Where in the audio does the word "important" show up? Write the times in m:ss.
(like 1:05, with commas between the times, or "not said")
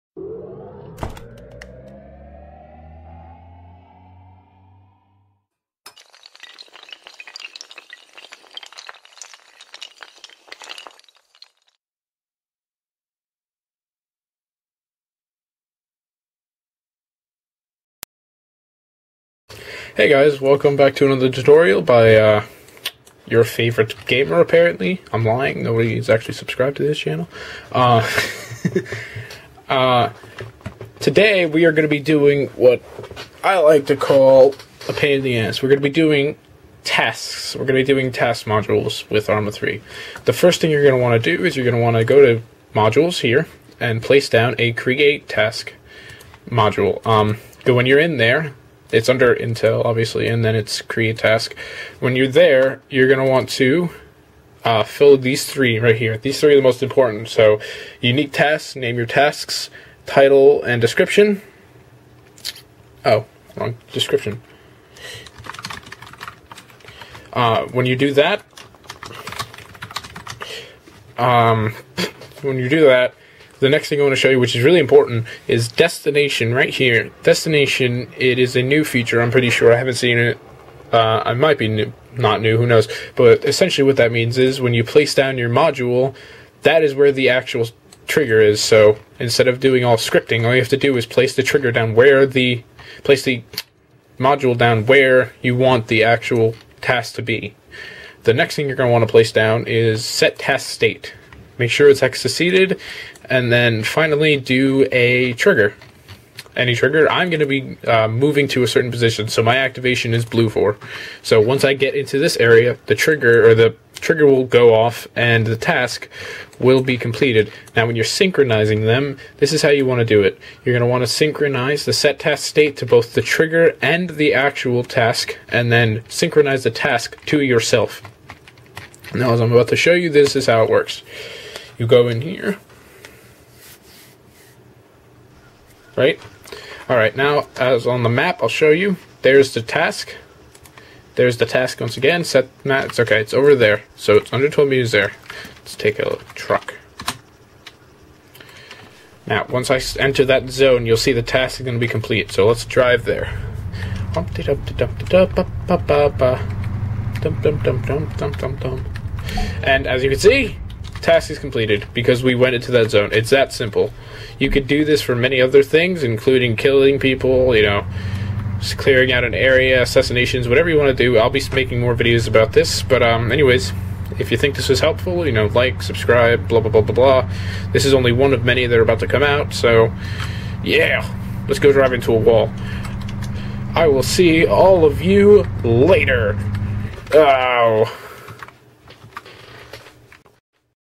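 0:56, 1:14.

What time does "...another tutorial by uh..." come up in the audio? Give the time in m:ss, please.
0:21.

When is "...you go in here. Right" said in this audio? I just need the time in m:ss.
2:11.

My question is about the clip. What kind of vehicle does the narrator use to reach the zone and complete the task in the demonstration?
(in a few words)
truck.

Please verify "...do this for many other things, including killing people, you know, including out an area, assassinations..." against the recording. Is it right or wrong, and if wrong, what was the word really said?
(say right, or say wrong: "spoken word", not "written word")
wrong: "clearing", not "including".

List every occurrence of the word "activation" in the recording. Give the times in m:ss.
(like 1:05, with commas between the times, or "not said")
1:49.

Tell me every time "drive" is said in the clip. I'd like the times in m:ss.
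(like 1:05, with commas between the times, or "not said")
2:32, 3:01.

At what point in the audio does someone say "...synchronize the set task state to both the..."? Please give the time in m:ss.
2:01.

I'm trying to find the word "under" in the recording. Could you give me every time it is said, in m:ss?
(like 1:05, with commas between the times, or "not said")
0:49, 2:24.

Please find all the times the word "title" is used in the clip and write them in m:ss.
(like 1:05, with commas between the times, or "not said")
1:00.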